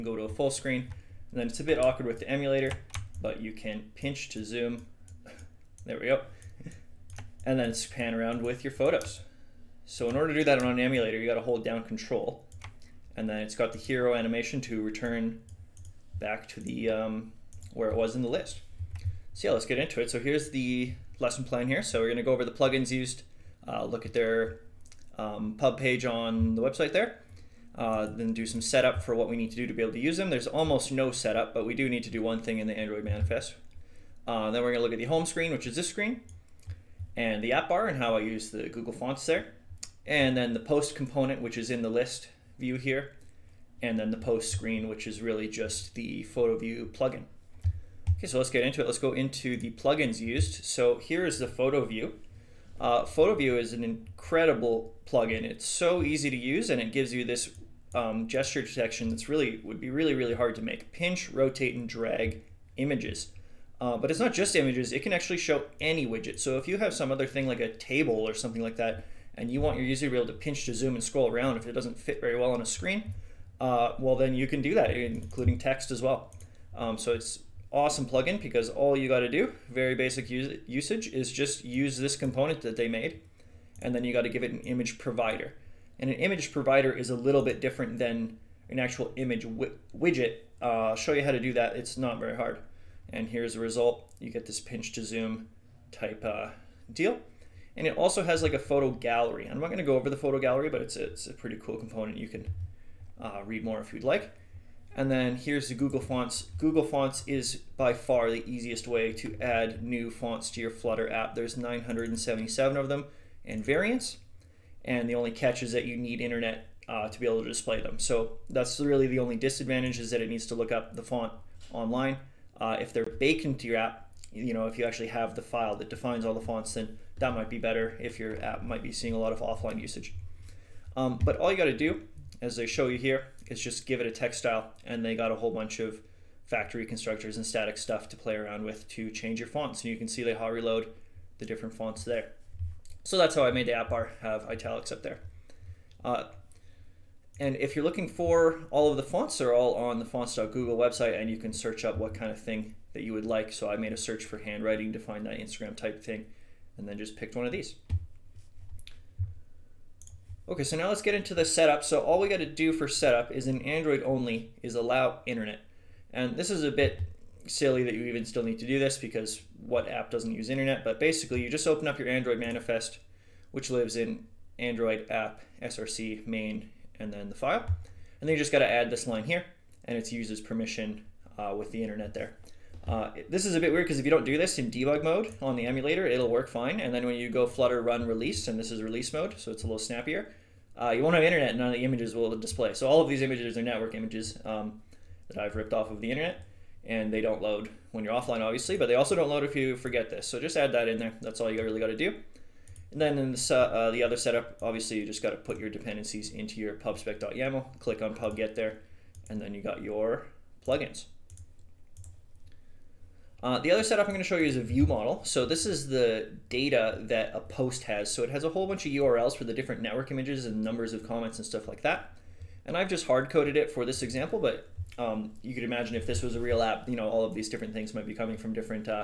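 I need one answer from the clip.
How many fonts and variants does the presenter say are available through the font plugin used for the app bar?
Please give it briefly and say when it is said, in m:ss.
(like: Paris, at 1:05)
977, at 1:51.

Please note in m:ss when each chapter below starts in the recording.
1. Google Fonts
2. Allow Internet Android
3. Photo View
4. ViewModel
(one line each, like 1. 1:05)
1. 1:45
2. 2:40
3. 0:45
4. 3:30.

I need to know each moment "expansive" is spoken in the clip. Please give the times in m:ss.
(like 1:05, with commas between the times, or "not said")
not said.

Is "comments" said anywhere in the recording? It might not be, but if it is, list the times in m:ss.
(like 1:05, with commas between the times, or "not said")
3:41.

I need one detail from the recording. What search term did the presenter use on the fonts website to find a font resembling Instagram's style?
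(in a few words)
handwriting.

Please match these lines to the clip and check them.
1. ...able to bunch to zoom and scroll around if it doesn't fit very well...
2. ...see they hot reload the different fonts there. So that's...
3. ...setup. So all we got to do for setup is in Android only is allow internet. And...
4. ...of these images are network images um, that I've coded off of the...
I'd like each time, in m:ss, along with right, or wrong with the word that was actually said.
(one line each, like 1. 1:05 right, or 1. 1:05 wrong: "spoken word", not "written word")
1. 1:10 wrong: "pinch", not "bunch"
2. 2:20 right
3. 2:41 right
4. 3:13 wrong: "ripped", not "coded".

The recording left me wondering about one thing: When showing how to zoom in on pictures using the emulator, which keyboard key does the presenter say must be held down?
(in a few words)
Control.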